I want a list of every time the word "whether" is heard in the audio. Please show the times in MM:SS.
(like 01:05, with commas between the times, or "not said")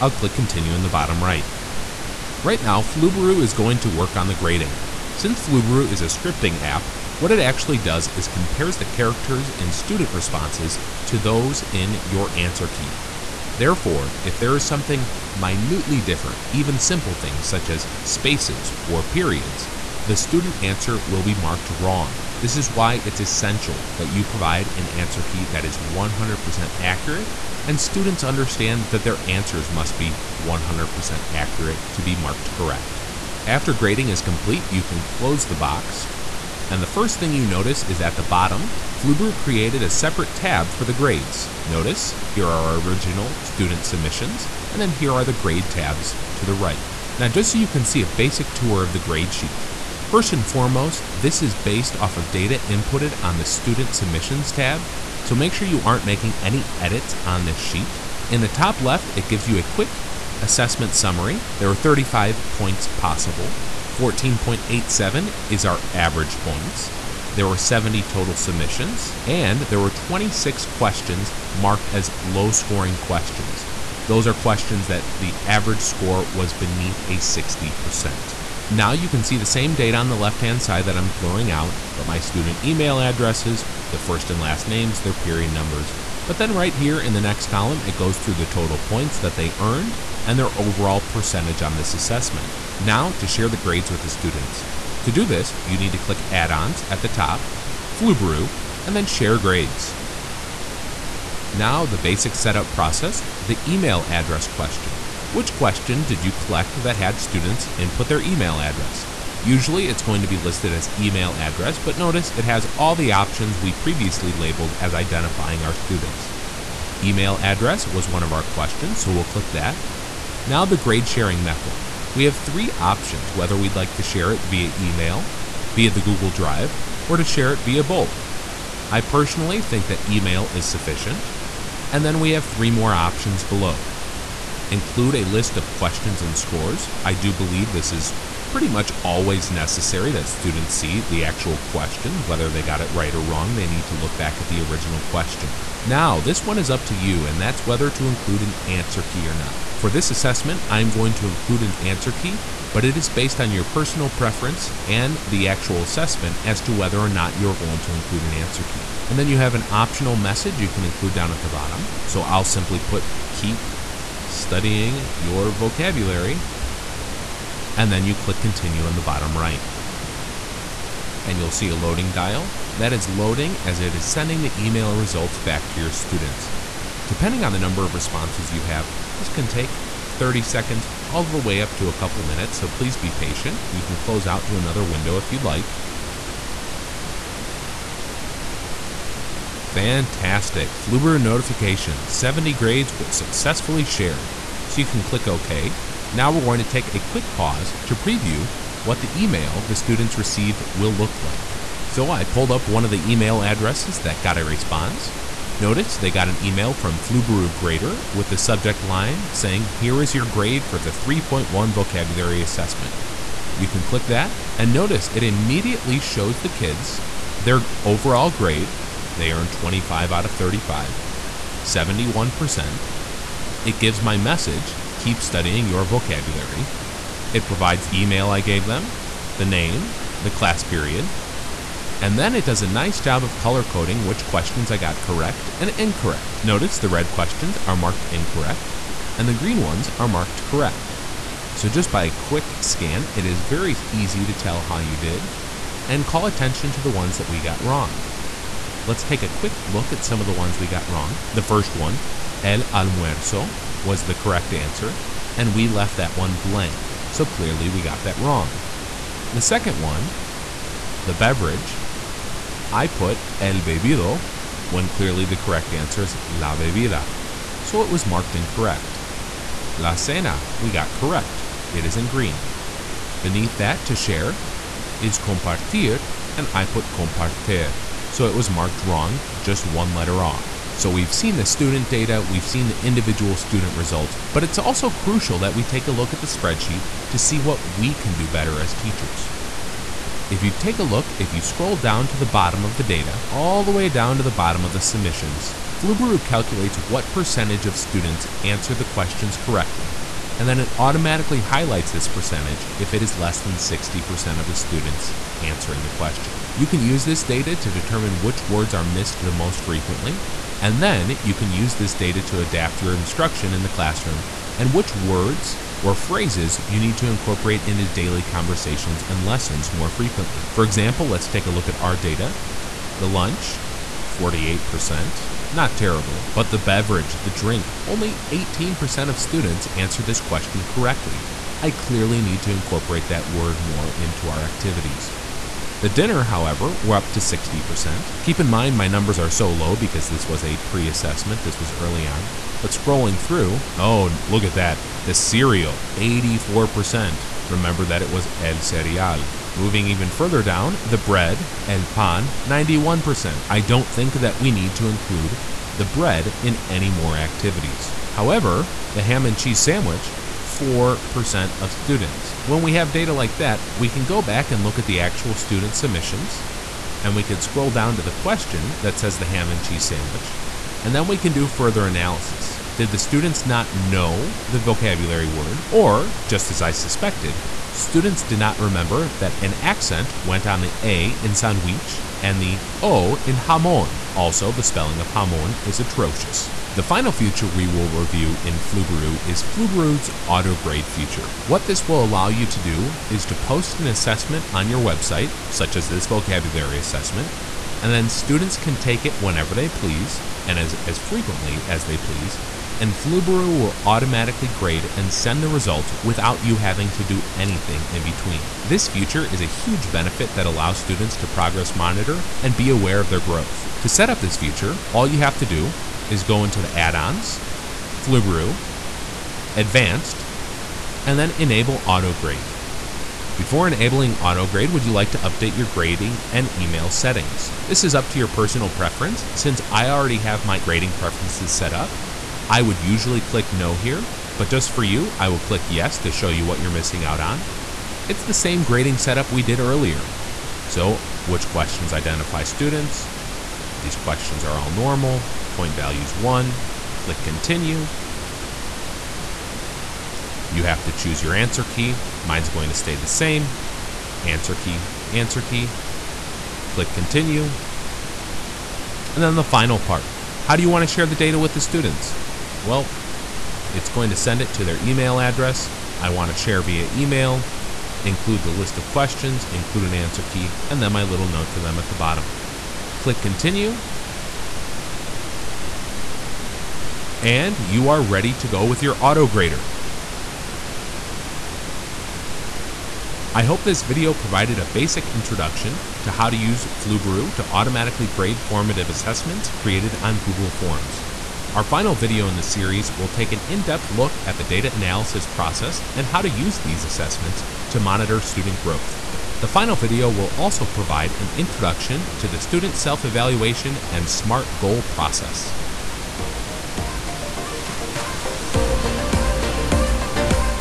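02:03, 02:22, 02:27, 02:36.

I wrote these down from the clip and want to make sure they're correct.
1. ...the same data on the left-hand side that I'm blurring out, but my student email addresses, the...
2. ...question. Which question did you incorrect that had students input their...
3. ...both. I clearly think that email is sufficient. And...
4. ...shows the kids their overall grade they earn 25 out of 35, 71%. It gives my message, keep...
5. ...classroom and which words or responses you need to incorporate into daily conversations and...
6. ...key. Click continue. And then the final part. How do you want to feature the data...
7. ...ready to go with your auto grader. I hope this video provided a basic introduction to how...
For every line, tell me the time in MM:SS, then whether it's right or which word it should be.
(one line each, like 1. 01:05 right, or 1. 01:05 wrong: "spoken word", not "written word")
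1. 01:19 right
2. 01:44 wrong: "collect", not "incorrect"
3. 02:07 wrong: "personally", not "clearly"
4. 03:35 right
5. 05:13 wrong: "phrases", not "responses"
6. 07:35 wrong: "share", not "feature"
7. 07:58 right.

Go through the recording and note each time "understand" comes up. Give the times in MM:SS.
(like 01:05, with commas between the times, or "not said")
00:28.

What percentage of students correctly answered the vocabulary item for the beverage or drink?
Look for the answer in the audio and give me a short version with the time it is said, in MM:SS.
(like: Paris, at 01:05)
18%, at 05:27.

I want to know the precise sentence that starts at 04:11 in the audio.
The first one, el almuerzo, was the correct answer, and we left that one blank, so clearly we got that wrong.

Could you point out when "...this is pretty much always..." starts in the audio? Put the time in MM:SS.
02:17.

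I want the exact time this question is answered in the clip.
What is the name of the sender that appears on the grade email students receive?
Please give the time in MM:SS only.
03:26.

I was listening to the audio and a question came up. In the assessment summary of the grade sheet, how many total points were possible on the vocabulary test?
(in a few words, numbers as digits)
35.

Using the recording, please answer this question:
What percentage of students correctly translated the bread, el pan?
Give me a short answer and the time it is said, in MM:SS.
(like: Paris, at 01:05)
91%, at 05:52.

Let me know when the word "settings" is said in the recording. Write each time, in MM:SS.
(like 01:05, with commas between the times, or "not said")
07:06.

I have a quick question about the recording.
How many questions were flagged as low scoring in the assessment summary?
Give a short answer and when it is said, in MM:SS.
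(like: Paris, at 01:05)
26, at 01:09.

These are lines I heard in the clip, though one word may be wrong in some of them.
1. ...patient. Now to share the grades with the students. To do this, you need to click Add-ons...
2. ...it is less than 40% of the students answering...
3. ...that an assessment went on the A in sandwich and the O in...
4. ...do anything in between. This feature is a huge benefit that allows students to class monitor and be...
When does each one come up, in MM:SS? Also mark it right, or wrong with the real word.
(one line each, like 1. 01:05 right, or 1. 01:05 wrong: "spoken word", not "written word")
1. 01:31 wrong: "assessment", not "patient"
2. 05:02 wrong: "60", not "40"
3. 06:19 wrong: "accent", not "assessment"
4. 06:47 wrong: "progress", not "class".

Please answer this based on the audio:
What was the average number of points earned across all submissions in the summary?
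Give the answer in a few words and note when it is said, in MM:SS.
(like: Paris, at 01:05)
14.87, at 01:03.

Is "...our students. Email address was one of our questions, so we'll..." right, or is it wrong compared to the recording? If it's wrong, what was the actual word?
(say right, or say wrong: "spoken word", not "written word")
right.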